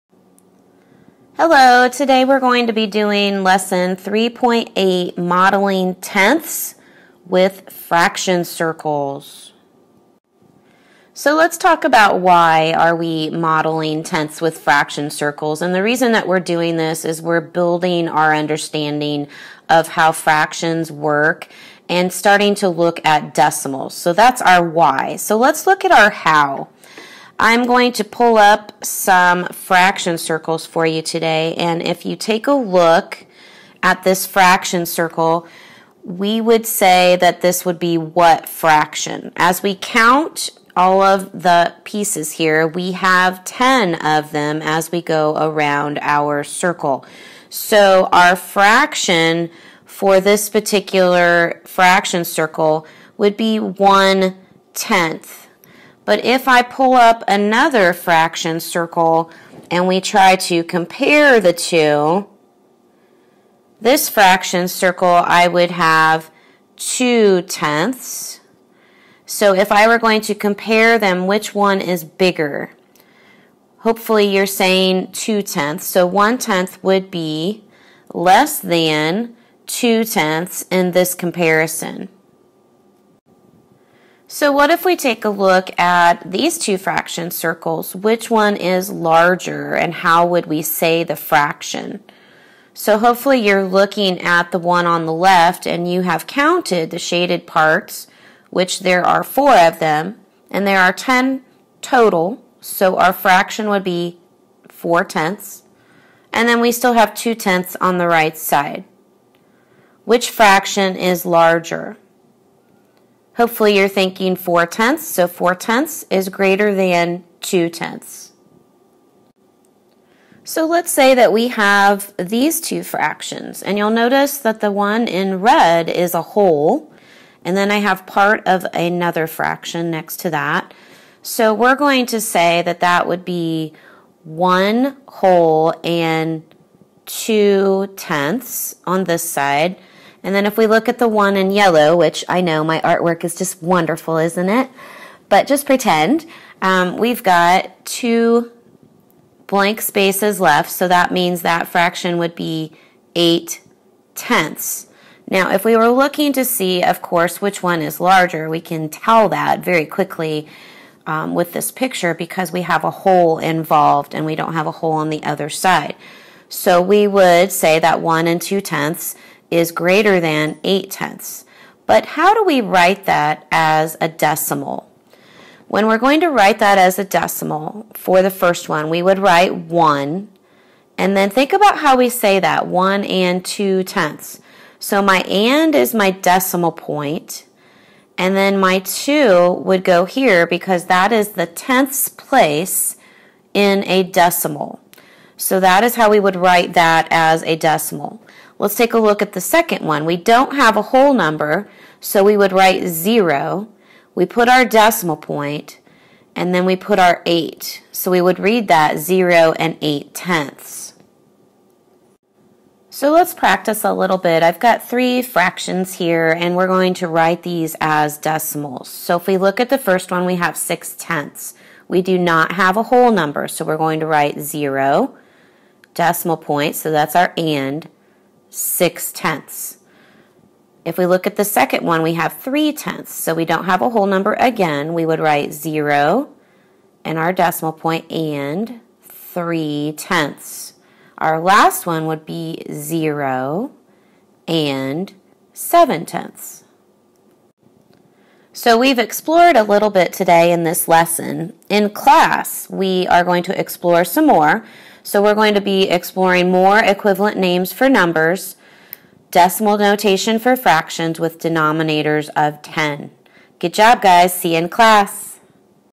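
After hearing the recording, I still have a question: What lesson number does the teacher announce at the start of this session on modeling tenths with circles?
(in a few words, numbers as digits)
3.8.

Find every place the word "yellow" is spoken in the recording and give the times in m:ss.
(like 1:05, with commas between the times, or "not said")
2:21.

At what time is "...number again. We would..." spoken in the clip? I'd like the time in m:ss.
3:54.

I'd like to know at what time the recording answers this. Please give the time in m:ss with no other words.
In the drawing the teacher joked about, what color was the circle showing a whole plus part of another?
2:05.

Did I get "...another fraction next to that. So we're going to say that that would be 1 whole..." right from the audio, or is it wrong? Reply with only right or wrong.
right.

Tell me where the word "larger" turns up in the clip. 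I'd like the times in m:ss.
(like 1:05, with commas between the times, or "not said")
1:28, 1:51, 2:37.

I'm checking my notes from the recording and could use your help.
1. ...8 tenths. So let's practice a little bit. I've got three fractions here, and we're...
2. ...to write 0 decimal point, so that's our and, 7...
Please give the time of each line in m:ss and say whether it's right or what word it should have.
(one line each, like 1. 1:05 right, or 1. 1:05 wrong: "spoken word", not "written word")
1. 3:29 right
2. 3:44 wrong: "6", not "7".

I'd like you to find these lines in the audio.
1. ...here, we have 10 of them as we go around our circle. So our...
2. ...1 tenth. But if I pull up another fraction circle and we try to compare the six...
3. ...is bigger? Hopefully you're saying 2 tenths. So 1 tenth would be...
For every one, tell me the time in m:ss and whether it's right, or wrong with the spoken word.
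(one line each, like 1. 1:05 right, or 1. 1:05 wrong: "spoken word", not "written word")
1. 0:42 right
2. 0:53 wrong: "two", not "six"
3. 1:11 right.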